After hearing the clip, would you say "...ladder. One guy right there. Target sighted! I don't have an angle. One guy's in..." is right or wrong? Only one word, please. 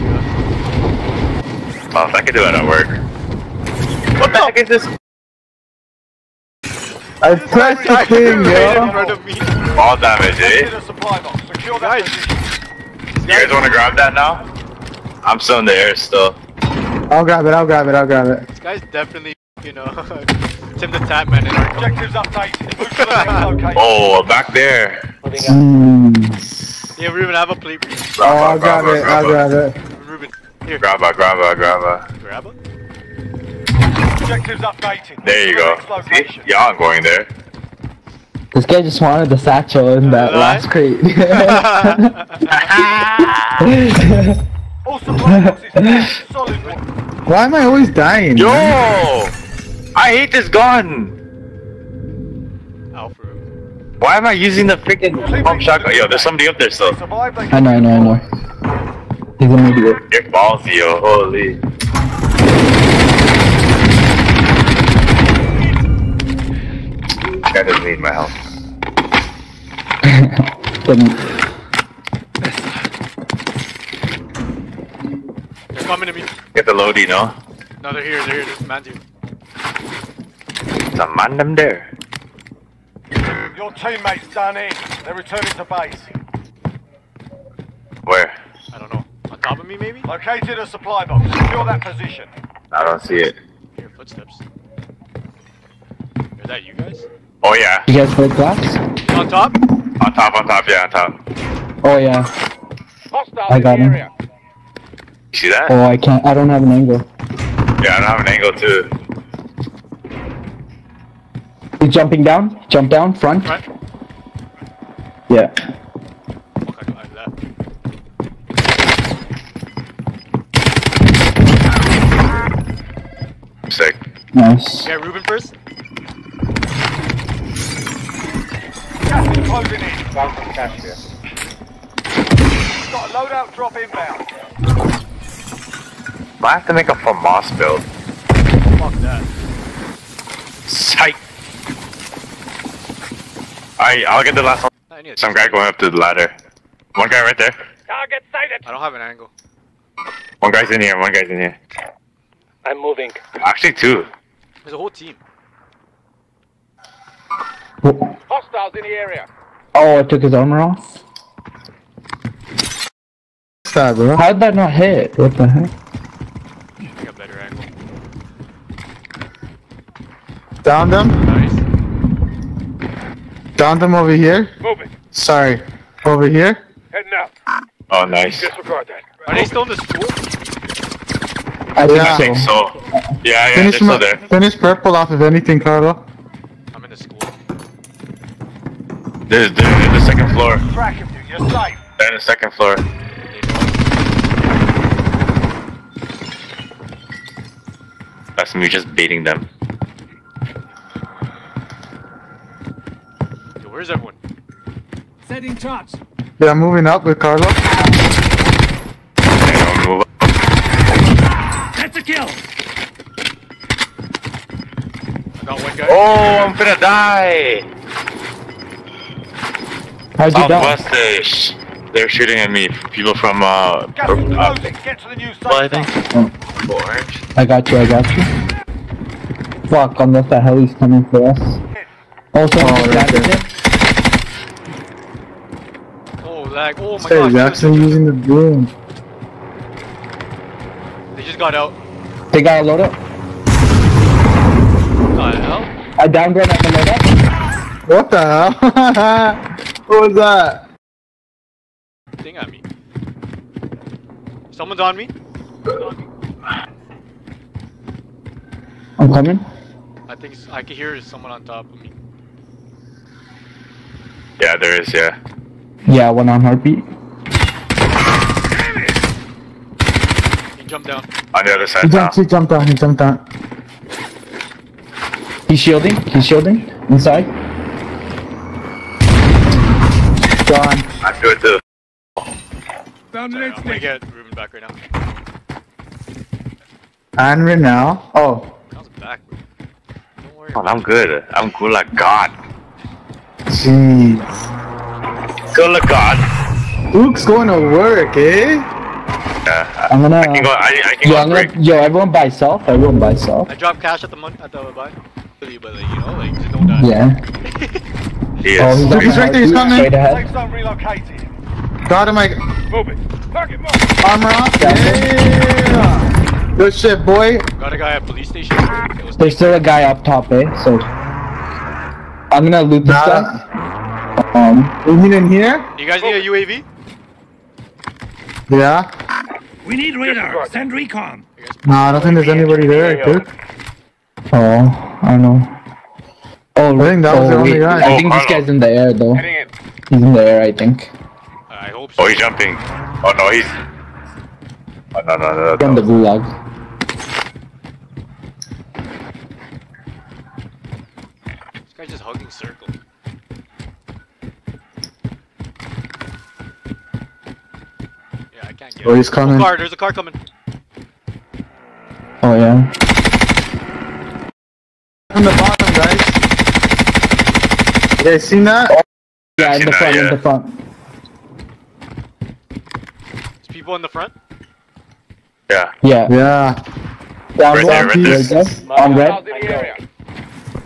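right.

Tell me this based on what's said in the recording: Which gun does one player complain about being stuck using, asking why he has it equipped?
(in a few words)
pump shotgun.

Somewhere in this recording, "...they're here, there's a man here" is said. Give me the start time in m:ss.
1:18.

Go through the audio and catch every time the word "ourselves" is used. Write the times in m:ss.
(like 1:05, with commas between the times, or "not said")
not said.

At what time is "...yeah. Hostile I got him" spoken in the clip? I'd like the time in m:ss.
1:41.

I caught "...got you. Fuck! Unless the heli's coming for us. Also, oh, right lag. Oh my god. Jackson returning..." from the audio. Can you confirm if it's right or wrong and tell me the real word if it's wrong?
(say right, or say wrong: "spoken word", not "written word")
wrong: "using", not "returning".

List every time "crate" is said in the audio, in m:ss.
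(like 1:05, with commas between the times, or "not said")
0:40.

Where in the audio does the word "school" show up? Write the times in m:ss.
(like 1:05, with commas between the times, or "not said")
2:59, 3:06.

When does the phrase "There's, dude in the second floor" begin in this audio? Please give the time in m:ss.
3:09.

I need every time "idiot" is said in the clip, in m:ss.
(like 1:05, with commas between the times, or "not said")
0:59.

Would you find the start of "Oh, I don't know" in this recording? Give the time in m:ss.
5:34.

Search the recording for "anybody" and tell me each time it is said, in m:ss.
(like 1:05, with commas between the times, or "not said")
5:32.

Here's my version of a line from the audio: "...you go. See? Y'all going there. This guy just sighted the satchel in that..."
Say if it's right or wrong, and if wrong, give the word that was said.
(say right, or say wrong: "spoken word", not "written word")
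wrong: "wanted", not "sighted".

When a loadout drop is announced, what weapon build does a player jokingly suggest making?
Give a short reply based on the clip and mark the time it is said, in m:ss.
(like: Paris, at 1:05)
FAMAS build, at 2:16.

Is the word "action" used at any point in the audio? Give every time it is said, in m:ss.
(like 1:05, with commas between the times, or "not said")
not said.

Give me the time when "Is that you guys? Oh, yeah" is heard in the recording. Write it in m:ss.
1:36.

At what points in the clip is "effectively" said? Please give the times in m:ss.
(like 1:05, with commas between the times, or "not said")
not said.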